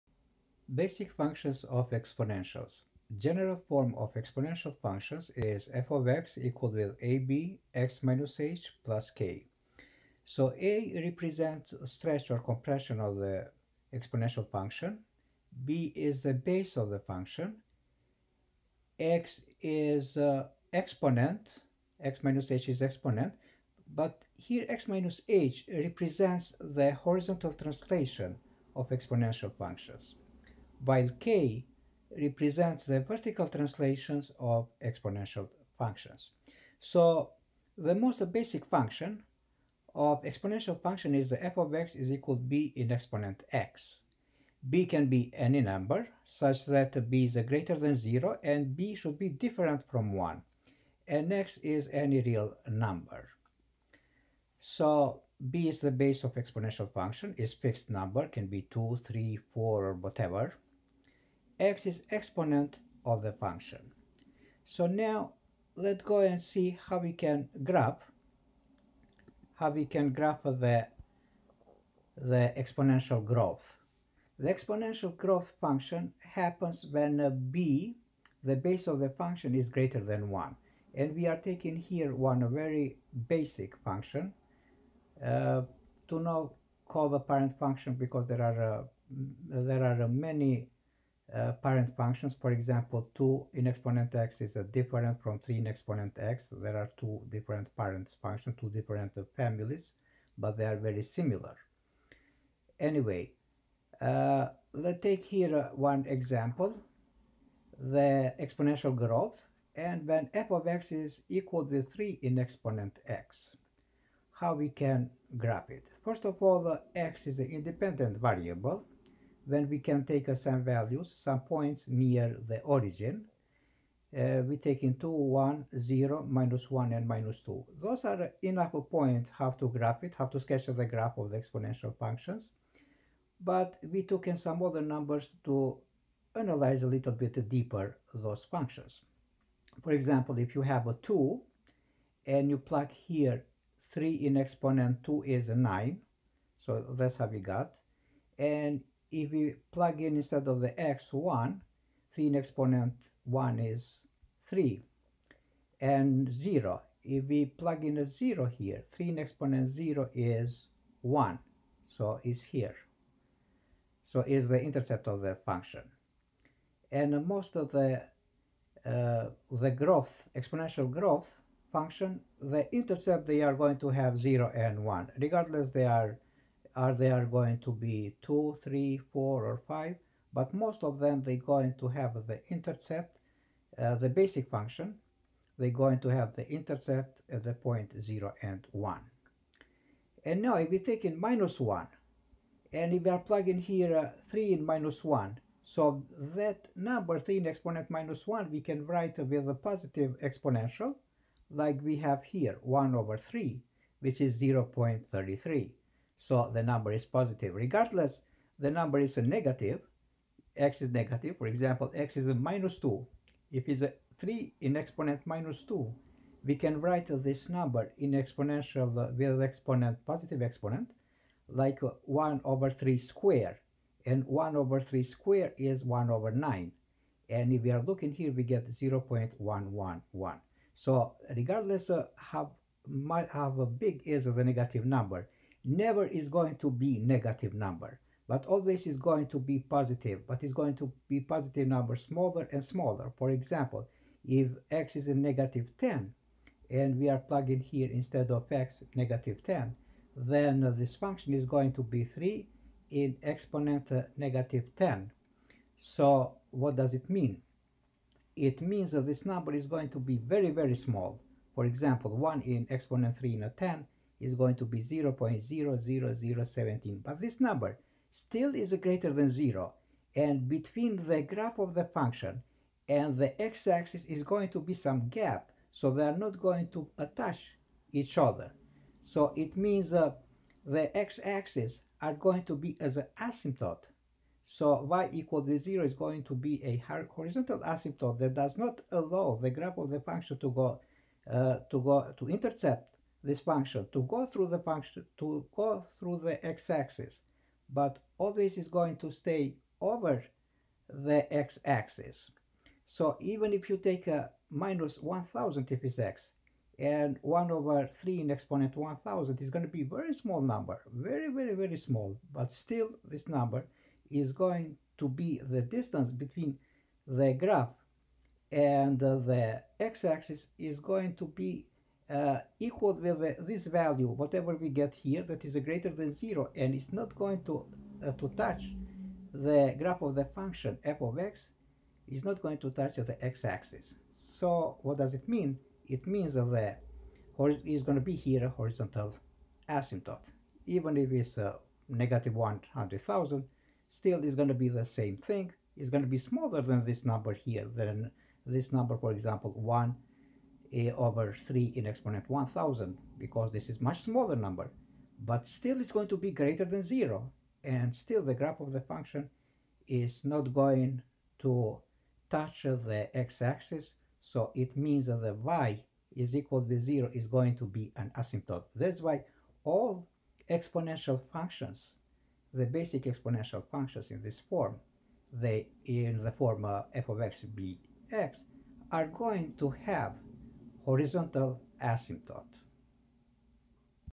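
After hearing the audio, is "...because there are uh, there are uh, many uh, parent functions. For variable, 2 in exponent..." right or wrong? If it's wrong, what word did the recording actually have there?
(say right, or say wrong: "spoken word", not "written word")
wrong: "example", not "variable".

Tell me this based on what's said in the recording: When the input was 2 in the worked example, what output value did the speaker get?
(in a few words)
9.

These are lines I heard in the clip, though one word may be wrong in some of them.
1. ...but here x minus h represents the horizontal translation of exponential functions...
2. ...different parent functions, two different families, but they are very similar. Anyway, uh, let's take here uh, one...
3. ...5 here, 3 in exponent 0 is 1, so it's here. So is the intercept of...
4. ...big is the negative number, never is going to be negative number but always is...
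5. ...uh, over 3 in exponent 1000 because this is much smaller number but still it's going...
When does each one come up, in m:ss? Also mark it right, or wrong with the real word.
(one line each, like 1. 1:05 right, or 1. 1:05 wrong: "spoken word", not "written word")
1. 0:23 right
2. 1:37 right
3. 2:38 wrong: "0", not "5"
4. 3:53 right
5. 5:50 right.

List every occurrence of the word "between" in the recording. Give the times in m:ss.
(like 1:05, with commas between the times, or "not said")
4:30, 5:16.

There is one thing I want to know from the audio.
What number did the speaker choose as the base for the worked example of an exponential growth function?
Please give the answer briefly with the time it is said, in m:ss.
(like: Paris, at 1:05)
3, at 1:50.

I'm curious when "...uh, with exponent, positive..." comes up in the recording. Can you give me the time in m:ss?
3:38.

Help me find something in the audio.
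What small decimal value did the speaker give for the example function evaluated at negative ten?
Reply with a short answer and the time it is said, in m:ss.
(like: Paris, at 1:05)
0.00017, at 4:24.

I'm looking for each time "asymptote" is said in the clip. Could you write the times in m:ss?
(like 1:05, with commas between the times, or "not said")
4:43, 4:47, 5:39, 6:08, 6:21.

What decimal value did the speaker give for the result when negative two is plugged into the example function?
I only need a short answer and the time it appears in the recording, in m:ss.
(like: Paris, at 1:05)
0.111, at 3:48.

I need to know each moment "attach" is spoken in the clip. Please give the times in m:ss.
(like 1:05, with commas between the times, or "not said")
4:36.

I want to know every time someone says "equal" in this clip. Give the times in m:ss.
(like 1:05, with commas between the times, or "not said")
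0:06, 0:42, 1:51, 4:45, 5:22, 6:06.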